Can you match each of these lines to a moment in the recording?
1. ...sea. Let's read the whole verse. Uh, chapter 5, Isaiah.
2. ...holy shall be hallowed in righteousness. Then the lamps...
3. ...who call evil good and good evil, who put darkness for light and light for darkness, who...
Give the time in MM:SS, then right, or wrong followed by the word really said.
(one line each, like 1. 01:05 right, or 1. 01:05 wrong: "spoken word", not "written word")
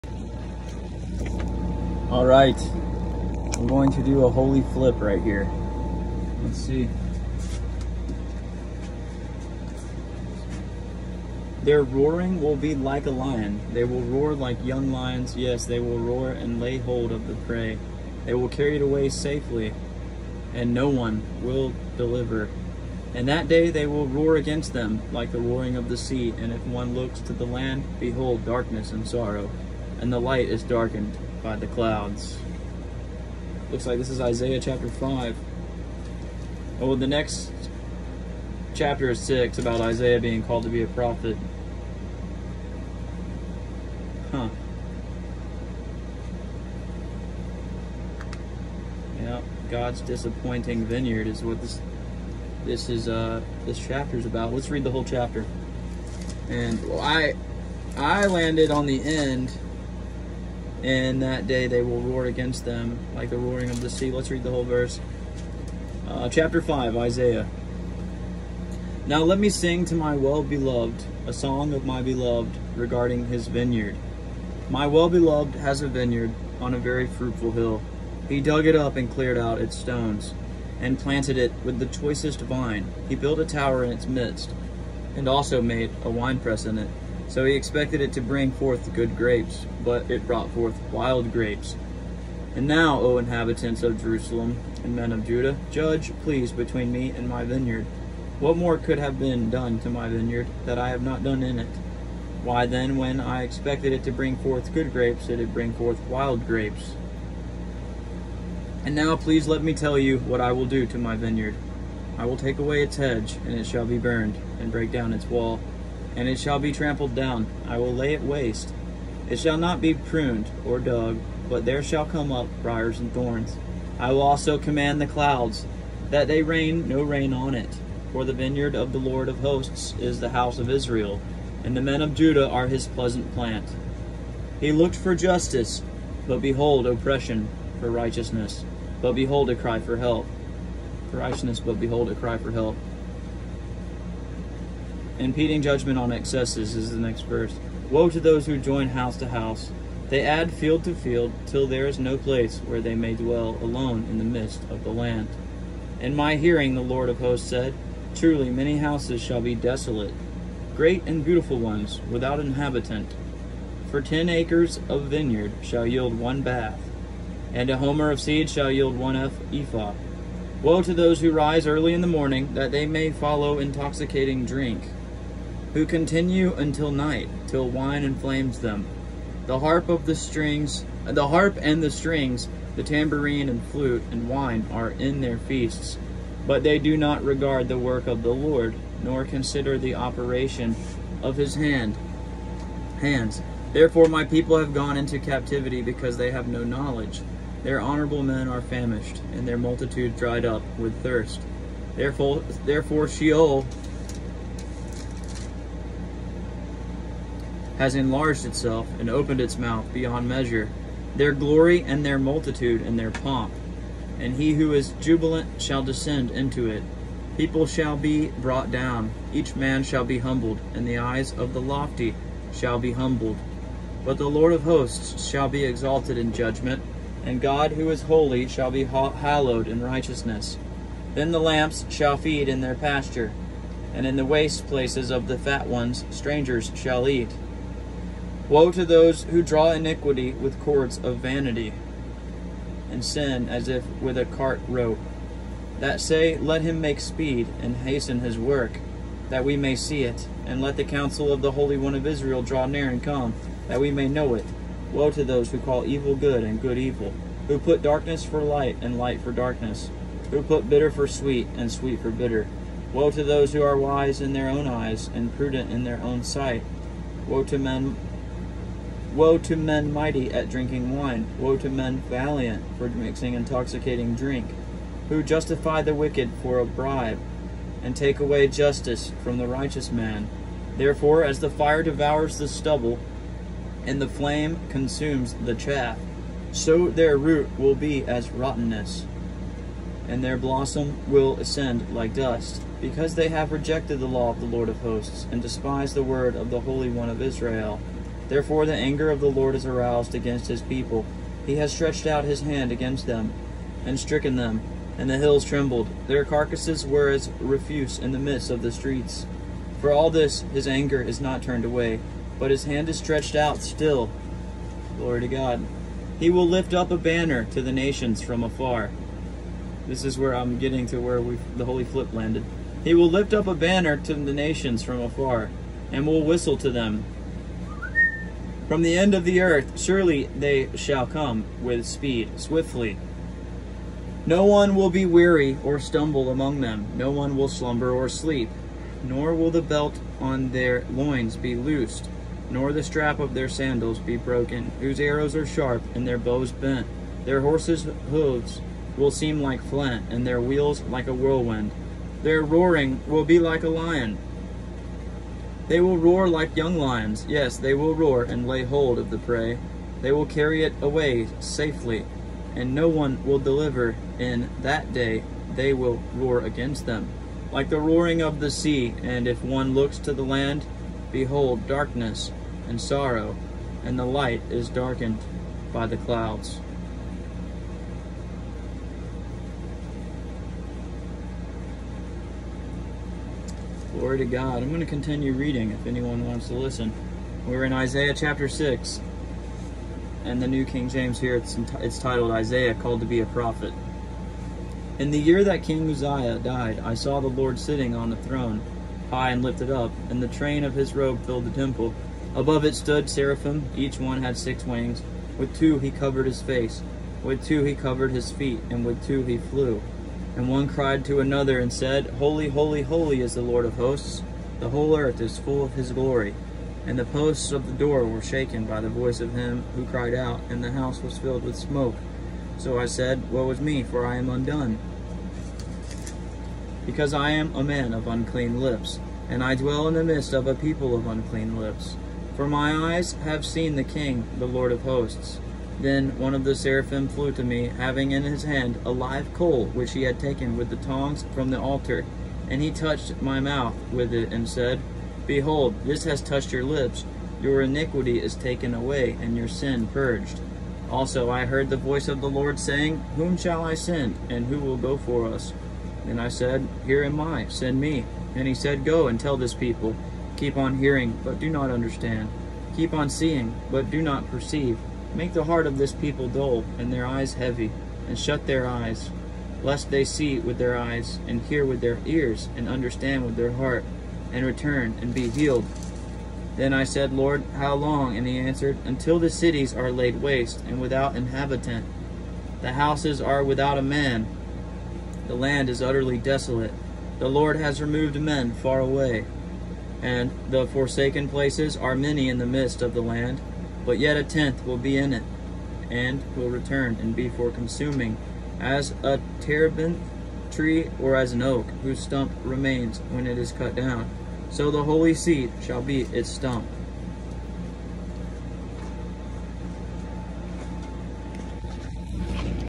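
1. 01:03 right
2. 03:48 right
3. 04:15 right.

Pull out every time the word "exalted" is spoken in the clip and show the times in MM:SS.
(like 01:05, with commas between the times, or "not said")
03:45.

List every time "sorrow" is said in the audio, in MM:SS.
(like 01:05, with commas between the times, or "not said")
00:29, 06:12.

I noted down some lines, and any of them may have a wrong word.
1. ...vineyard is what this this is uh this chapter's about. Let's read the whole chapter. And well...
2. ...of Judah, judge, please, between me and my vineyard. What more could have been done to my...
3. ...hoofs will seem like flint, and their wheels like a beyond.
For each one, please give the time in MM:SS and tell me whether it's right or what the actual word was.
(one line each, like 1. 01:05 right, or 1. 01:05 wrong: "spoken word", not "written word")
1. 00:50 right
2. 01:35 right
3. 05:48 wrong: "whirlwind", not "beyond".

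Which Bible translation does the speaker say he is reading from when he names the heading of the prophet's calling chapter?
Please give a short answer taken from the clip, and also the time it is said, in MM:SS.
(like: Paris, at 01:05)
New King James, at 06:30.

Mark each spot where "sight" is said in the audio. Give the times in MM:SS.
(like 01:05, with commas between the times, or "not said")
04:26.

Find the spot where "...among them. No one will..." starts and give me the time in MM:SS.
05:36.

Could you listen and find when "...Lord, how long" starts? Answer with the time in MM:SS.
07:57.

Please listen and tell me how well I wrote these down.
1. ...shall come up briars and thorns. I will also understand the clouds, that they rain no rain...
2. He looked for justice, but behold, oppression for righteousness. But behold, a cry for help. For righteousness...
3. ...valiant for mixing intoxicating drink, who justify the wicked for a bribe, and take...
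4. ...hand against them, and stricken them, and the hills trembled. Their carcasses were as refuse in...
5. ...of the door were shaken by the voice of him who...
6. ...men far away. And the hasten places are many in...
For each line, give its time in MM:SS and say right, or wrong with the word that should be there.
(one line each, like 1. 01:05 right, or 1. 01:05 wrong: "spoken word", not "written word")
1. 02:01 wrong: "command", not "understand"
2. 02:14 right
3. 04:32 right
4. 05:02 right
5. 06:57 right
6. 08:08 wrong: "forsaken", not "hasten".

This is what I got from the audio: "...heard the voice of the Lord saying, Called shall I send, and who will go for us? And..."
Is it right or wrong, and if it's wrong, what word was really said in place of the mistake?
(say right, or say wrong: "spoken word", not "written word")
wrong: "Whom", not "Called".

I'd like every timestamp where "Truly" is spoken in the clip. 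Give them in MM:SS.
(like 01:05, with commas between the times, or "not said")
02:38.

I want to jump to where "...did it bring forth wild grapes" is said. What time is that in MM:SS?
01:45.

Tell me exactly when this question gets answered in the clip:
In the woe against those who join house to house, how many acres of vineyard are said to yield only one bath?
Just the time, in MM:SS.
02:44.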